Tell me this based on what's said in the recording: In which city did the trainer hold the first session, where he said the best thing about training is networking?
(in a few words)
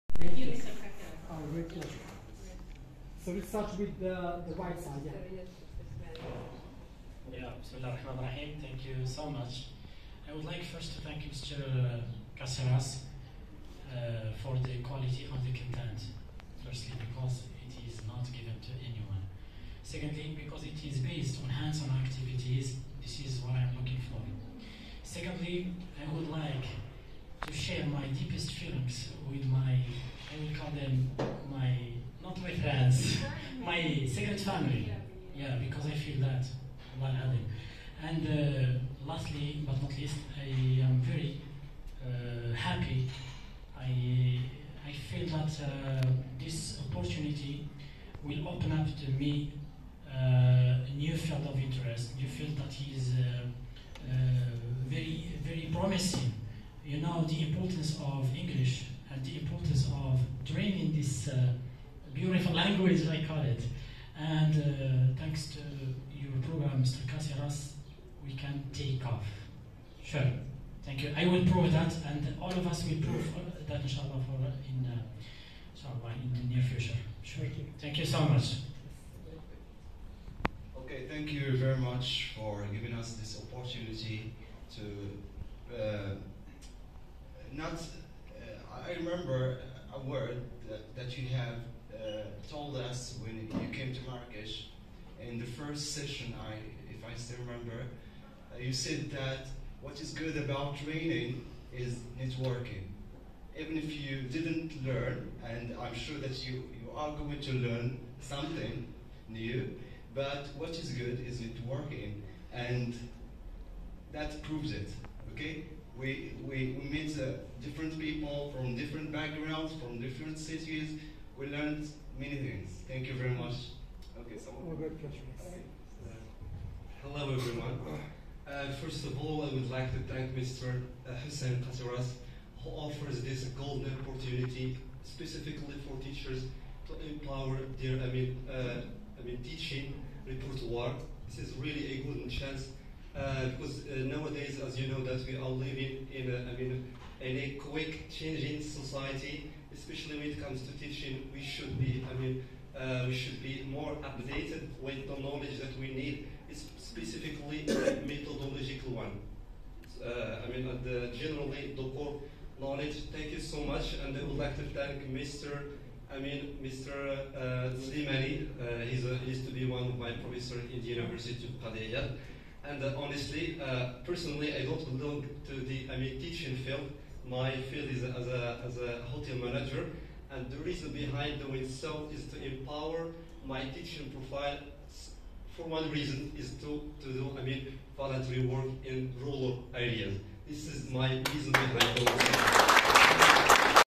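Marrakesh.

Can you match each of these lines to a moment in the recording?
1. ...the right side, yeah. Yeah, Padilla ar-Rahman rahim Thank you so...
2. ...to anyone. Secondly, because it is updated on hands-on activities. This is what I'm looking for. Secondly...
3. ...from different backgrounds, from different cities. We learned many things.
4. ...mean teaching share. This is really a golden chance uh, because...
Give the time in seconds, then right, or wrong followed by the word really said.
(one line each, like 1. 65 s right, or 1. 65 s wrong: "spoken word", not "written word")
1. 4 s wrong: "Bismillah", not "Padilla"
2. 18 s wrong: "based", not "updated"
3. 118 s right
4. 139 s wrong: "repertoire", not "share".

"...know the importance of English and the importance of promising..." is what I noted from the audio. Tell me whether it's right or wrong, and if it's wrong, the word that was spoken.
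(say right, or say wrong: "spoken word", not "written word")
wrong: "training", not "promising".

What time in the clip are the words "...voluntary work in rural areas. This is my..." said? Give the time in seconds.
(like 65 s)
187 s.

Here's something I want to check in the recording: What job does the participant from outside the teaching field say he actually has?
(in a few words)
Hotel manager.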